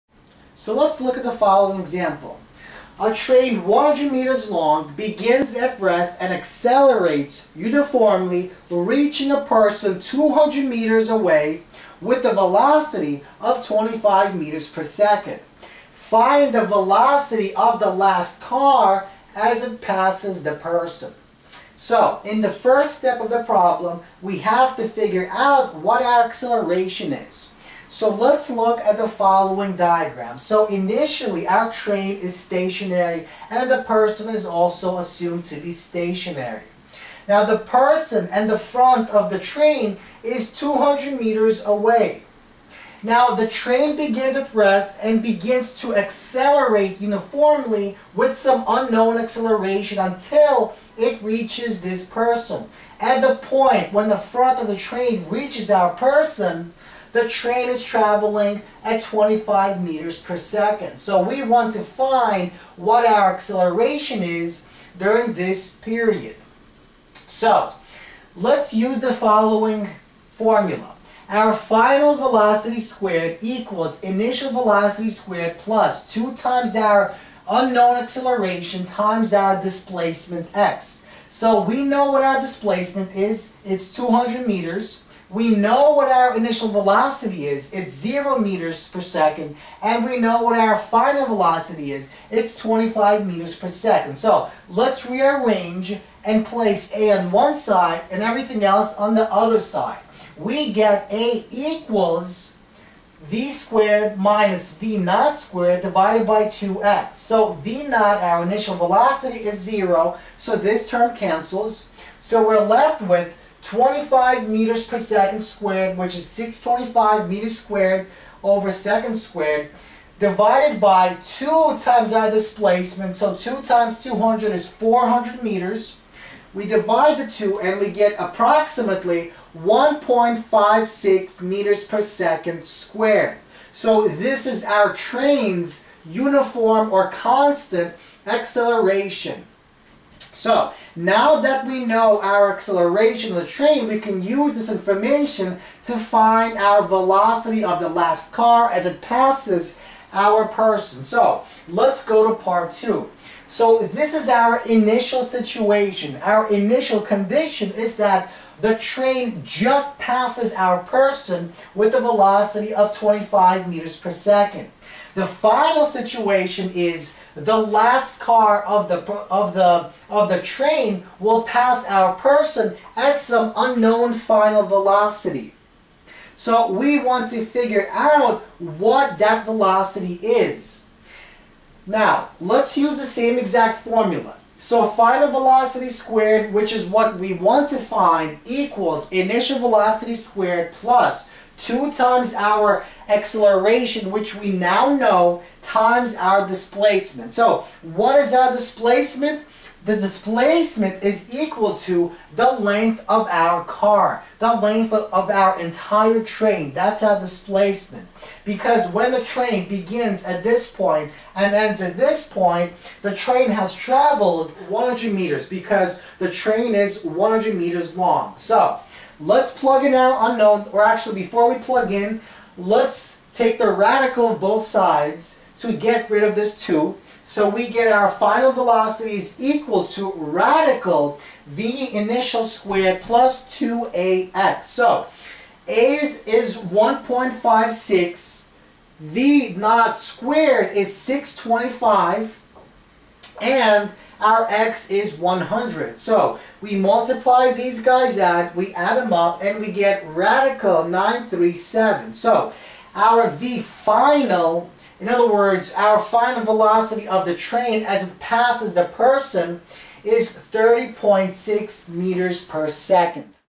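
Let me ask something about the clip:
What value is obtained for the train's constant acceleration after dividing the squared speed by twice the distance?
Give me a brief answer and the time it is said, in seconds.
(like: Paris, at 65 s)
1.56 meters per second squared, at 129 s.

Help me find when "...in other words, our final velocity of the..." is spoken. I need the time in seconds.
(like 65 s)
255 s.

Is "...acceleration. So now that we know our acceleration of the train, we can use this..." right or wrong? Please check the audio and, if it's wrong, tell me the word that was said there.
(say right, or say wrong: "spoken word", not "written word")
right.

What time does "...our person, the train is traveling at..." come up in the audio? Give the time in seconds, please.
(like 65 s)
55 s.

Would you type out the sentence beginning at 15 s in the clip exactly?
Find the velocity of the last car as it passes the person.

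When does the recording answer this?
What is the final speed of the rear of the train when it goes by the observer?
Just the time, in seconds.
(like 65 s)
260 s.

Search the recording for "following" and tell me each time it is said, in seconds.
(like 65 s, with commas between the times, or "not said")
1 s, 29 s, 69 s.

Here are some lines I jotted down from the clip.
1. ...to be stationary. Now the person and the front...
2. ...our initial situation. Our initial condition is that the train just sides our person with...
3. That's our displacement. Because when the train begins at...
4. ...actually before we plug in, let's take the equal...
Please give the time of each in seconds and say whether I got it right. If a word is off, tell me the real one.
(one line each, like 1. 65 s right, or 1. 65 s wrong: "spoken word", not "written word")
1. 35 s right
2. 154 s wrong: "passes", not "sides"
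3. 206 s right
4. 220 s wrong: "radical", not "equal".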